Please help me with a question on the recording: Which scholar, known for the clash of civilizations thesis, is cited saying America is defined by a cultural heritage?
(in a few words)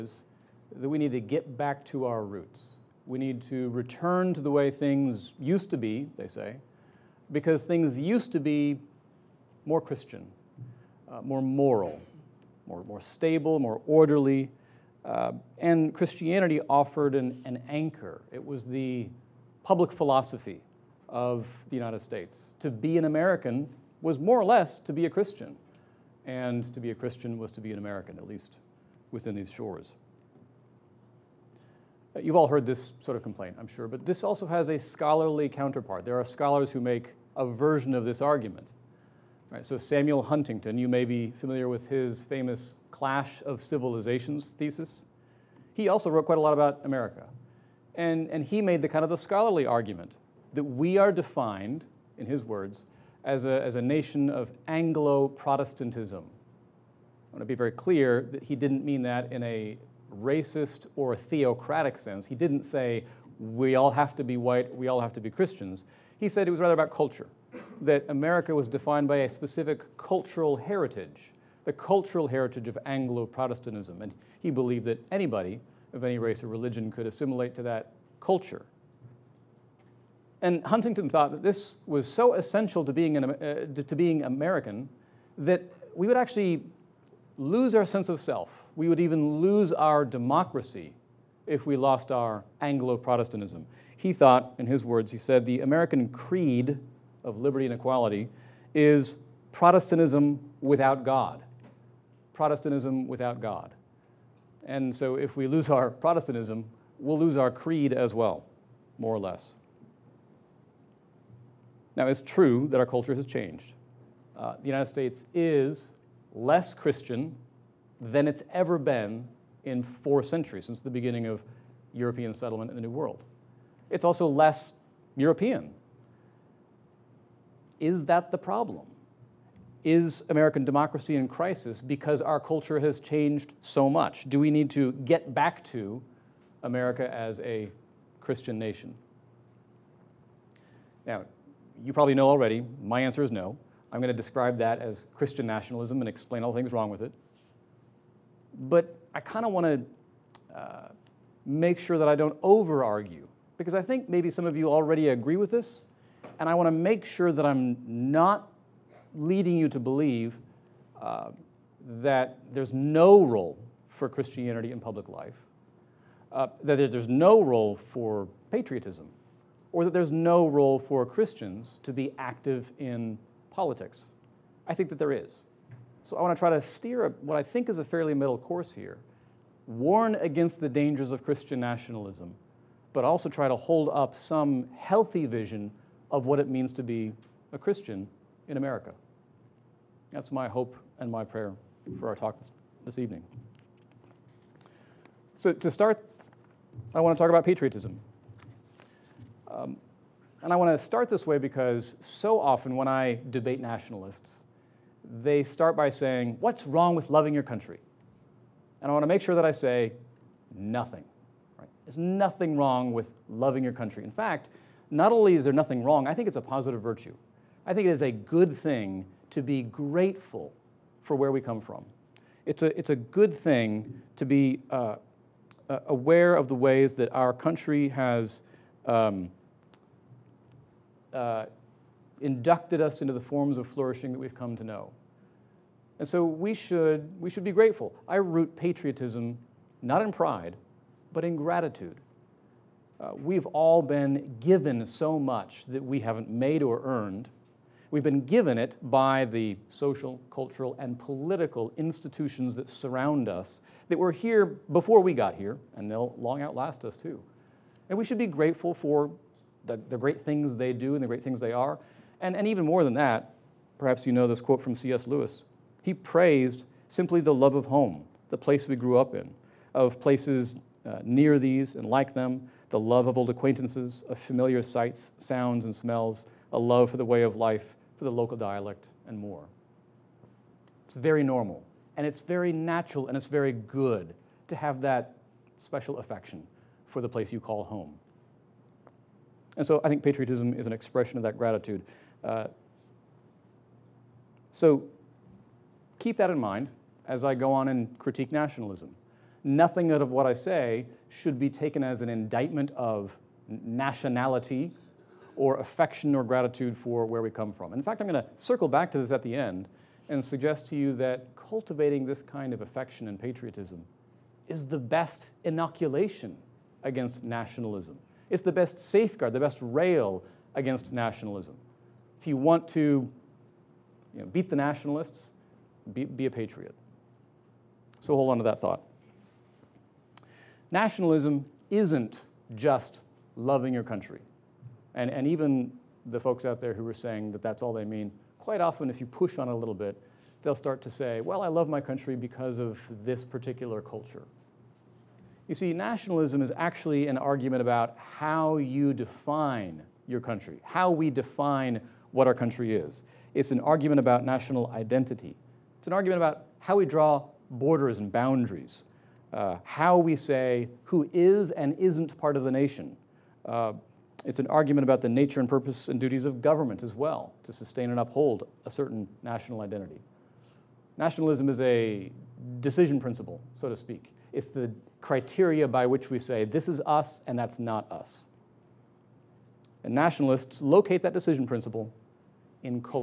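Samuel Huntington.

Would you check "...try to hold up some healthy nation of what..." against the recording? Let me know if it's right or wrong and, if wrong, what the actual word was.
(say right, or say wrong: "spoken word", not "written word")
wrong: "vision", not "nation".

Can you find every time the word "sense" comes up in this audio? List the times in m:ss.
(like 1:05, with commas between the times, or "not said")
1:01, 1:27.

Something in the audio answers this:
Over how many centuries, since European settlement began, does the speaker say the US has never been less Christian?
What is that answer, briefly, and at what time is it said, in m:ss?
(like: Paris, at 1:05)
4, at 1:59.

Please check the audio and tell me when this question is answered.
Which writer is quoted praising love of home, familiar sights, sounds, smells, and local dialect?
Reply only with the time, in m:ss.
4:24.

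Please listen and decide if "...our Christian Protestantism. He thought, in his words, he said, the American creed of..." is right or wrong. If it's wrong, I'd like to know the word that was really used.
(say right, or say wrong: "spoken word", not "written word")
wrong: "Anglo", not "Christian".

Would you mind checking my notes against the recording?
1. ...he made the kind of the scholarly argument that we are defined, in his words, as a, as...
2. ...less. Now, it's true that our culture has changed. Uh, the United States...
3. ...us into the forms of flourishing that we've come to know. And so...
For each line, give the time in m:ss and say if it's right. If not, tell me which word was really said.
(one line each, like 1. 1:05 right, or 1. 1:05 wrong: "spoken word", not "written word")
1. 0:48 right
2. 1:49 right
3. 3:52 right.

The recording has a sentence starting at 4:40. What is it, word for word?
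It's very normal, and it's very natural, and it's very good to have that special affection for the place you call home.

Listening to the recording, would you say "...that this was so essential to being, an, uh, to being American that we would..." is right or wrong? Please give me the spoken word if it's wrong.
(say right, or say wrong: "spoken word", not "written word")
right.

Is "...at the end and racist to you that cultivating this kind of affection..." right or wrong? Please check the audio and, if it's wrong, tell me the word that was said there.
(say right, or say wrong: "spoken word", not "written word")
wrong: "suggest", not "racist".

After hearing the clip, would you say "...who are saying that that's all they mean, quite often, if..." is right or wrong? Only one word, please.
right.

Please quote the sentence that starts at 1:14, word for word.
And he believed that anybody of any race or religion could assimilate to that culture.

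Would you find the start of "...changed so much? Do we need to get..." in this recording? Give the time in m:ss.
2:13.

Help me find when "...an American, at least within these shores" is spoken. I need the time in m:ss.
0:27.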